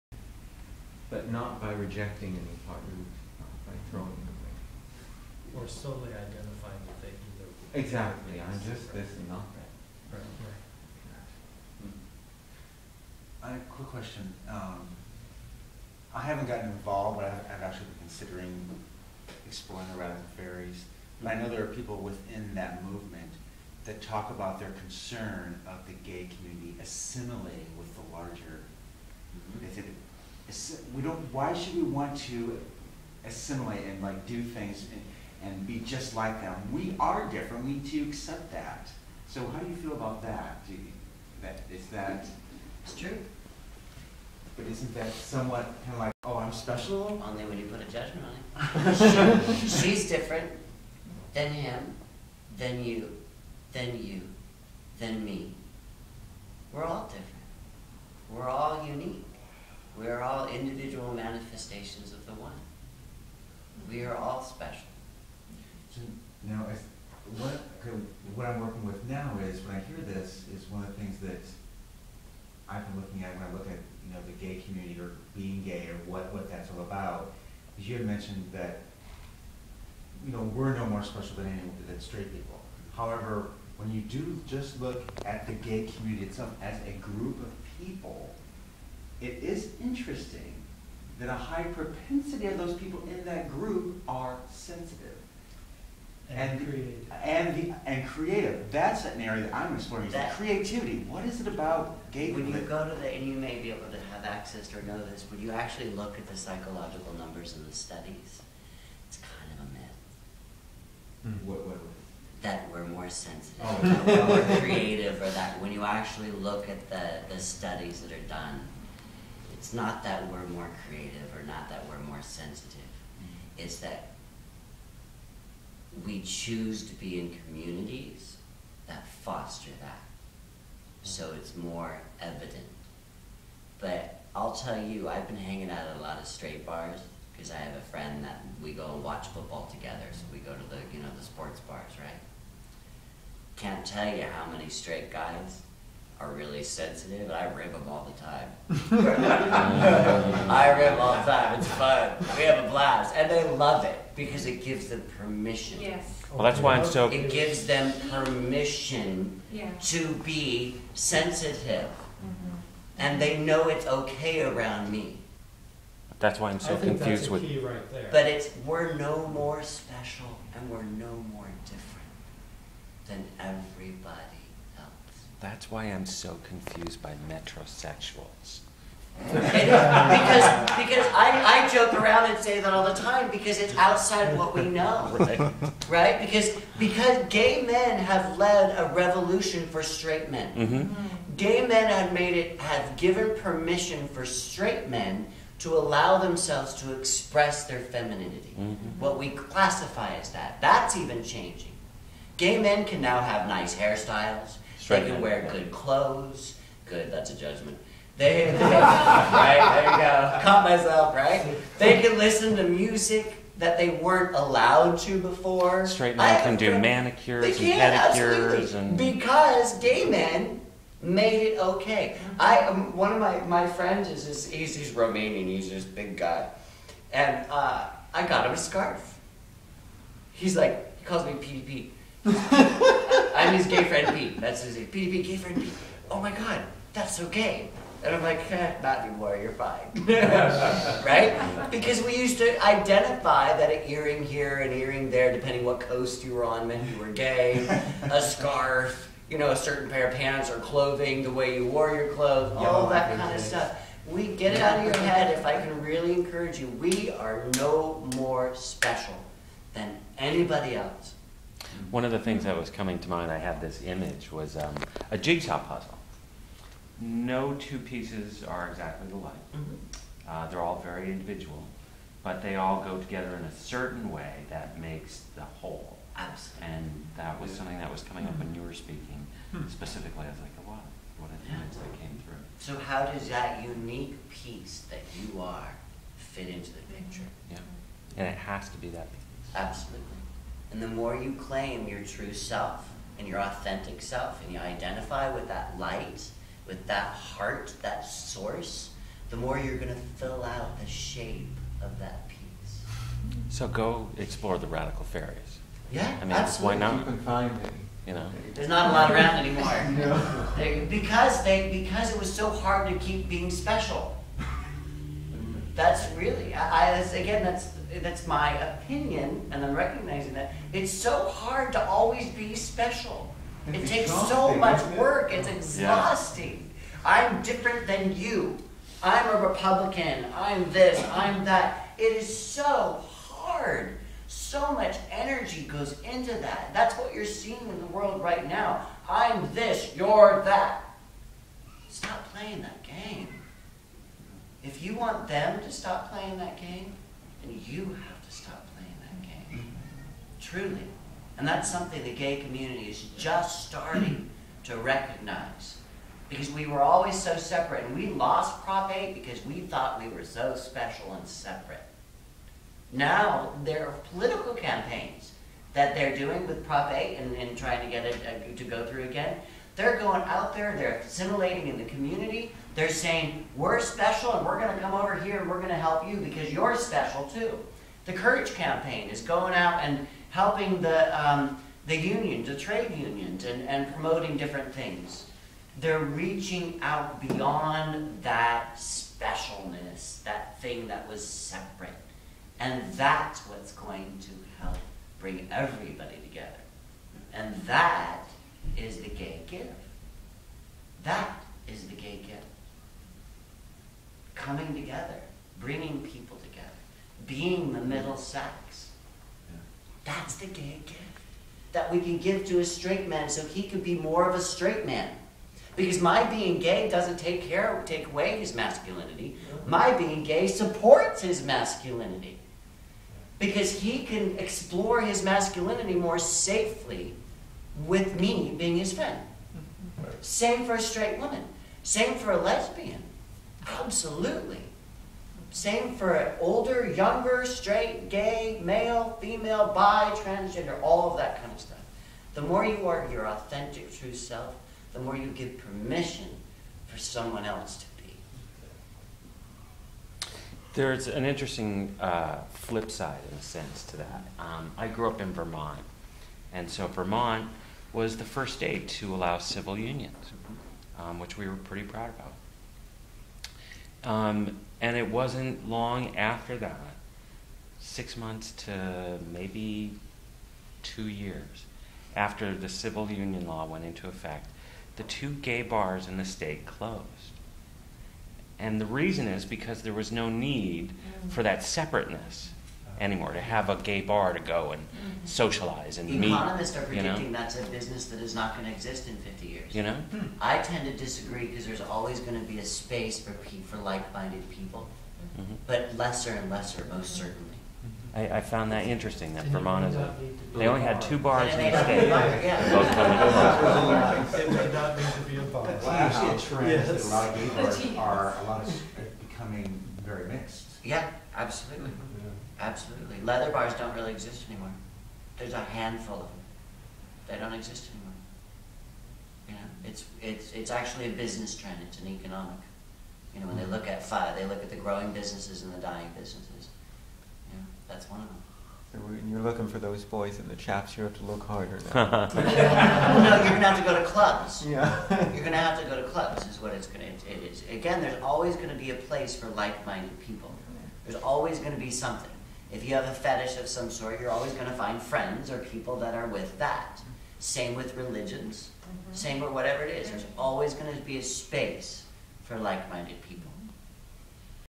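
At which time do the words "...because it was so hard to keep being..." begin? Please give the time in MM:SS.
05:11.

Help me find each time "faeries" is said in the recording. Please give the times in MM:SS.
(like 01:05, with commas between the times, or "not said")
00:20, 05:05.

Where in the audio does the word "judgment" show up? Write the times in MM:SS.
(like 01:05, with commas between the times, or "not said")
00:47, 03:27.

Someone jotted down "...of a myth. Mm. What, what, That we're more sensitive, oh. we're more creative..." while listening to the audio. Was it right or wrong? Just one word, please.
right.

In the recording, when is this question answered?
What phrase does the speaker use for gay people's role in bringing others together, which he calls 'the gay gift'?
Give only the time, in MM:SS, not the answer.
06:47.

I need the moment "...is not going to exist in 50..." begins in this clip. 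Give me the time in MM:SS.
08:08.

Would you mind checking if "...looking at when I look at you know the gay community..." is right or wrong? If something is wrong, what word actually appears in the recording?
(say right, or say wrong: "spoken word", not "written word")
right.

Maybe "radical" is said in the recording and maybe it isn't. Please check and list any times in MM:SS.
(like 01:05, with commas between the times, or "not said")
00:19, 05:04.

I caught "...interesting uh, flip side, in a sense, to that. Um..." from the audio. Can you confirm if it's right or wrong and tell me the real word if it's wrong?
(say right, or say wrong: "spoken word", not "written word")
right.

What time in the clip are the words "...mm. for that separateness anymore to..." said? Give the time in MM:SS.
08:00.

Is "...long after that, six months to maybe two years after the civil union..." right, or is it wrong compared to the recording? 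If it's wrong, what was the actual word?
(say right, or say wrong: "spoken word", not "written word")
right.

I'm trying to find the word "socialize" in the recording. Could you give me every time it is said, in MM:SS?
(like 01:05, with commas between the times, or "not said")
08:05.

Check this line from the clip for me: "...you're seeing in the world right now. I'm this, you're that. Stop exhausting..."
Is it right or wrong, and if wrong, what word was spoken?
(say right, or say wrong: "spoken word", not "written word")
wrong: "playing", not "exhausting".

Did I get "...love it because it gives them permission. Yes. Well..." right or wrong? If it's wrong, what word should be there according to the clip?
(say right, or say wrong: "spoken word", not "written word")
right.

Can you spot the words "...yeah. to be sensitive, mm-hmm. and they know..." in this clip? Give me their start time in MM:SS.
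02:39.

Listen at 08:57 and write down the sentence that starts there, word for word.
Again, there's always going to be a place for like-minded people.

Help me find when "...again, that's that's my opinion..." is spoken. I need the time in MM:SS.
05:16.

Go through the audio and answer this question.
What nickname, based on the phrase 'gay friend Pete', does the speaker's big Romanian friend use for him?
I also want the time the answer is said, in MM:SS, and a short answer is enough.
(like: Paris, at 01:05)
PDP, at 03:51.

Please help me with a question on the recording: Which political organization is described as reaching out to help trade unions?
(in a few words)
The Courage Campaign.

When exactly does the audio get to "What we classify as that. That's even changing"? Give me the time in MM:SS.
03:19.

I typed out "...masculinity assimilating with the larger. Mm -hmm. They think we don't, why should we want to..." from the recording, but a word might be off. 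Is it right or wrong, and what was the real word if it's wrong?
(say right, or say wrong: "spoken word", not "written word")
wrong: "community", not "masculinity".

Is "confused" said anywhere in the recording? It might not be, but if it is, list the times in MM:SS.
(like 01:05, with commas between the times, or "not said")
02:46, 02:56.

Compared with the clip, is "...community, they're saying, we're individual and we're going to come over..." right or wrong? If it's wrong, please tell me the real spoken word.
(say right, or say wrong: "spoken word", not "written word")
wrong: "special", not "individual".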